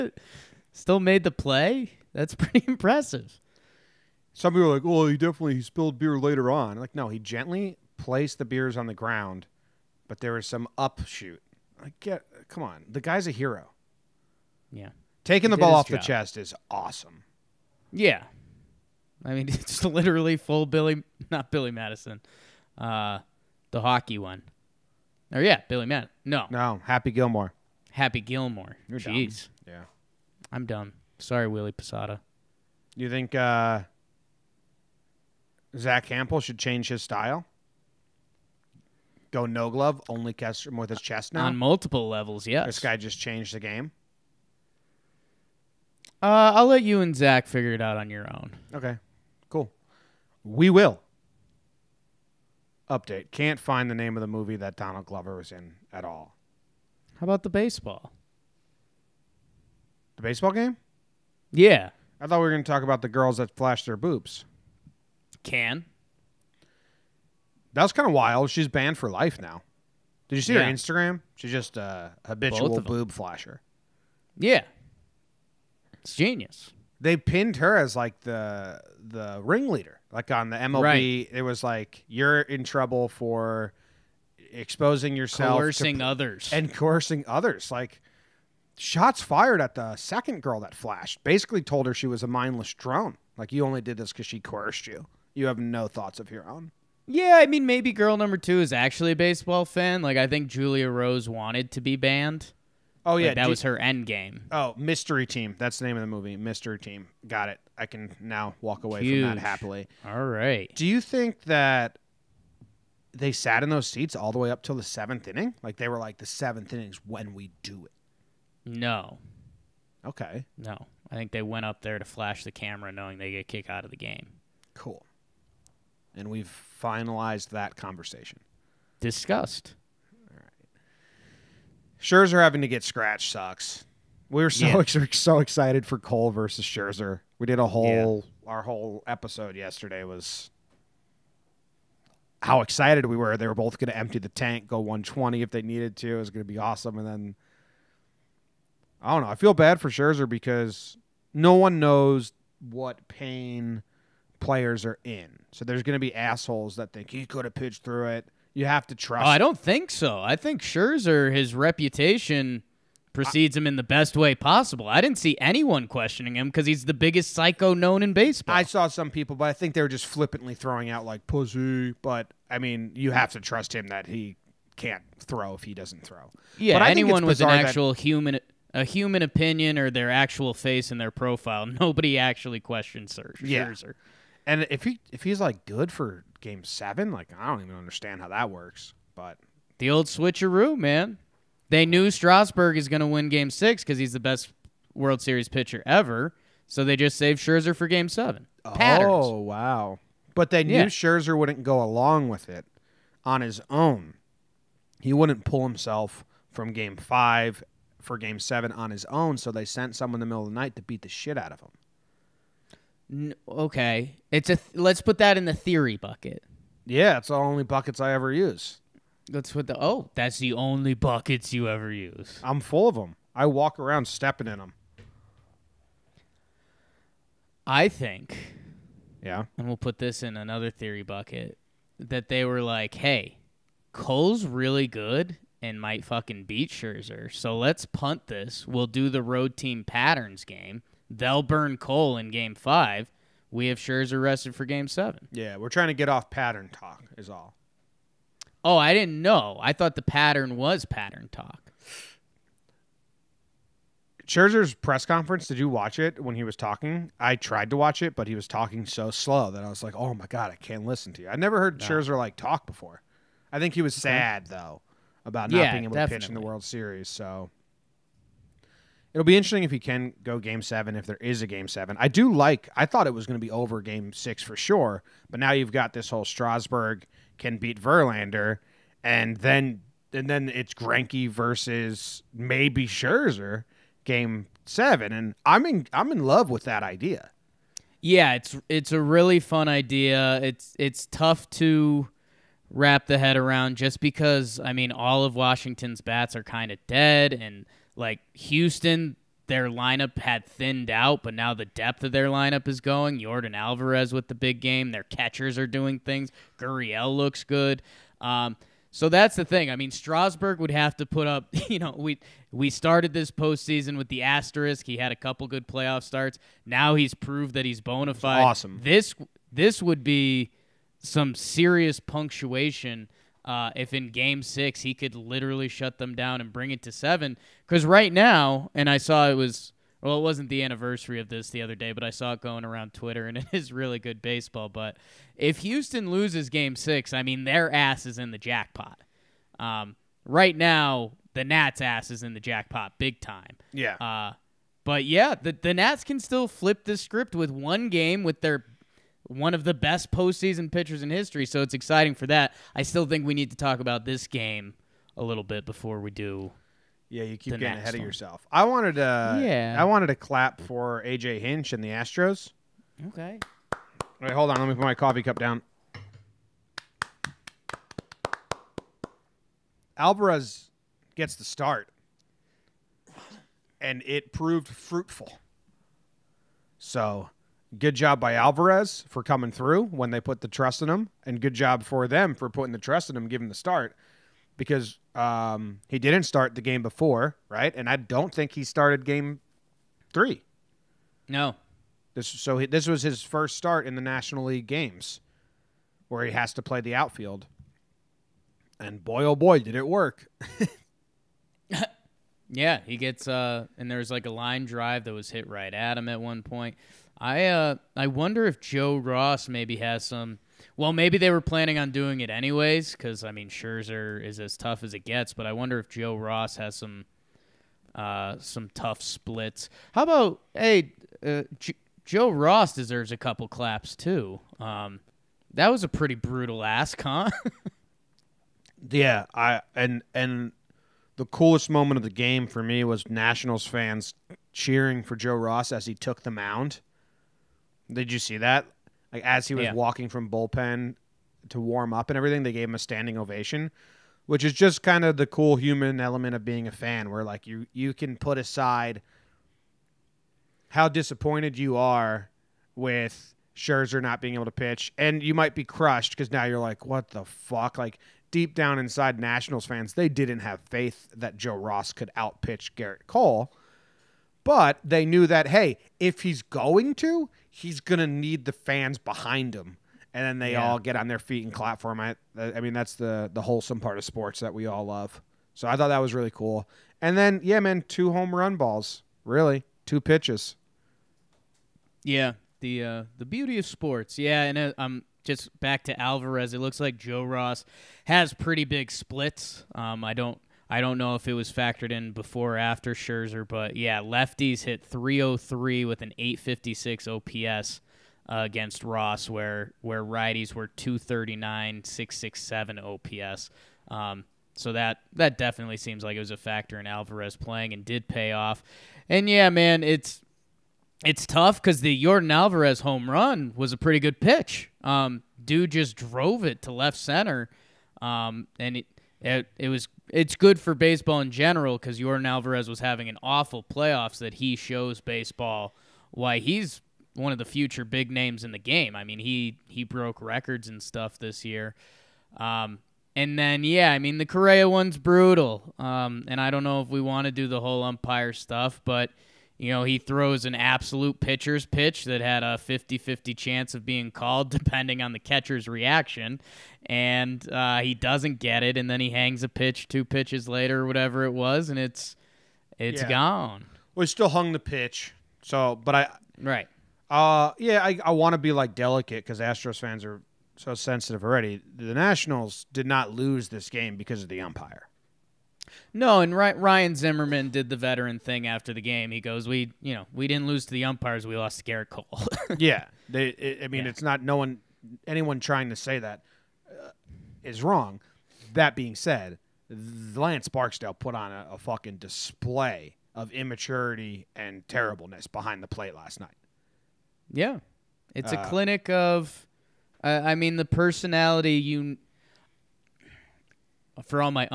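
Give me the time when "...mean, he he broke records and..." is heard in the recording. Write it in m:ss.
8:49.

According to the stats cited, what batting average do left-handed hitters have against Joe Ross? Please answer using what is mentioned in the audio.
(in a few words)
.303.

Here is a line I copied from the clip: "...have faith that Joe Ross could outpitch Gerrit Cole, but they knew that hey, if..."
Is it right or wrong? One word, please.
right.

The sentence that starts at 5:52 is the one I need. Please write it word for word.
I still think we need to talk about this game a little bit before we do.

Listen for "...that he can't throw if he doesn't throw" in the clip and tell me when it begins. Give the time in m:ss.
2:53.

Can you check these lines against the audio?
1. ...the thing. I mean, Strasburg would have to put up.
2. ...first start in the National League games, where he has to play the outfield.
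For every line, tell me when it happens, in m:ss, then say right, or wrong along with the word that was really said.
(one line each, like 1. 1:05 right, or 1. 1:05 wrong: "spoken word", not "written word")
1. 5:09 right
2. 6:33 right.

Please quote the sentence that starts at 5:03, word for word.
Yordan Alvarez with the big game.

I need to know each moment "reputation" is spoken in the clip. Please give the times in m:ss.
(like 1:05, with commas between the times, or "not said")
2:41.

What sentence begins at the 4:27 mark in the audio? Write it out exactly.
So It'll be interesting if he can go game seven, if there is a game seven.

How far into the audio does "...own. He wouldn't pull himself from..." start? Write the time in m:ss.
3:23.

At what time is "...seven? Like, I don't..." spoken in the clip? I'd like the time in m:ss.
3:06.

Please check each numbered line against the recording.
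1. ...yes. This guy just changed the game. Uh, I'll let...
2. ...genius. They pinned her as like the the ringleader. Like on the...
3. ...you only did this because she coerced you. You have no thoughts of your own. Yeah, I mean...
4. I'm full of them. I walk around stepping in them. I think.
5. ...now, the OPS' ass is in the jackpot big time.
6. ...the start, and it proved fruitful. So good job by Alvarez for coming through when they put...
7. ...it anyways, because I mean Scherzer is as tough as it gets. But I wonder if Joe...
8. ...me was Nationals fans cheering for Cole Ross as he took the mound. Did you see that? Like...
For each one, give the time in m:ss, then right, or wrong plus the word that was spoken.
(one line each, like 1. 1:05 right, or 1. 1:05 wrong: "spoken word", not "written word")
1. 0:42 right
2. 1:16 right
3. 1:33 right
4. 3:42 right
5. 5:40 wrong: "Nats", not "OPS"
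6. 6:11 right
7. 6:52 right
8. 7:12 wrong: "Joe", not "Cole".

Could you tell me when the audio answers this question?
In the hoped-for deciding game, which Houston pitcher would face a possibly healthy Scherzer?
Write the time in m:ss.
4:40.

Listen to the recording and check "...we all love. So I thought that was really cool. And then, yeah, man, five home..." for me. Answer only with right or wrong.
wrong.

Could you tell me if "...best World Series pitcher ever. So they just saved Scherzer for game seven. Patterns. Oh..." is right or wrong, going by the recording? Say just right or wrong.
right.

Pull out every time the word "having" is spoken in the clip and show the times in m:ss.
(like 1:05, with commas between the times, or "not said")
2:12, 8:42.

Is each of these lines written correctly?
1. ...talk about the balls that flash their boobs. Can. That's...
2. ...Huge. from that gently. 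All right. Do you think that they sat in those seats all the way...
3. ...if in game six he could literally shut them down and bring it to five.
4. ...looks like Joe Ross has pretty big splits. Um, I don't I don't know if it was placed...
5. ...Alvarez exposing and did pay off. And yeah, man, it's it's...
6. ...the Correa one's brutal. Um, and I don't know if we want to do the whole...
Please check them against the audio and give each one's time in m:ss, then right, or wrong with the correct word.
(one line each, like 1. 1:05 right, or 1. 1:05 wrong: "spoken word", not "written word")
1. 1:02 wrong: "girls", not "balls"
2. 1:49 wrong: "happily", not "gently"
3. 5:23 wrong: "seven", not "five"
4. 8:06 wrong: "factored", not "placed"
5. 8:26 wrong: "playing", not "exposing"
6. 8:54 right.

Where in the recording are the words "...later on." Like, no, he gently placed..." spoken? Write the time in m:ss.
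0:06.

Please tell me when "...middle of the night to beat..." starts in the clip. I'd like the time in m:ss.
3:30.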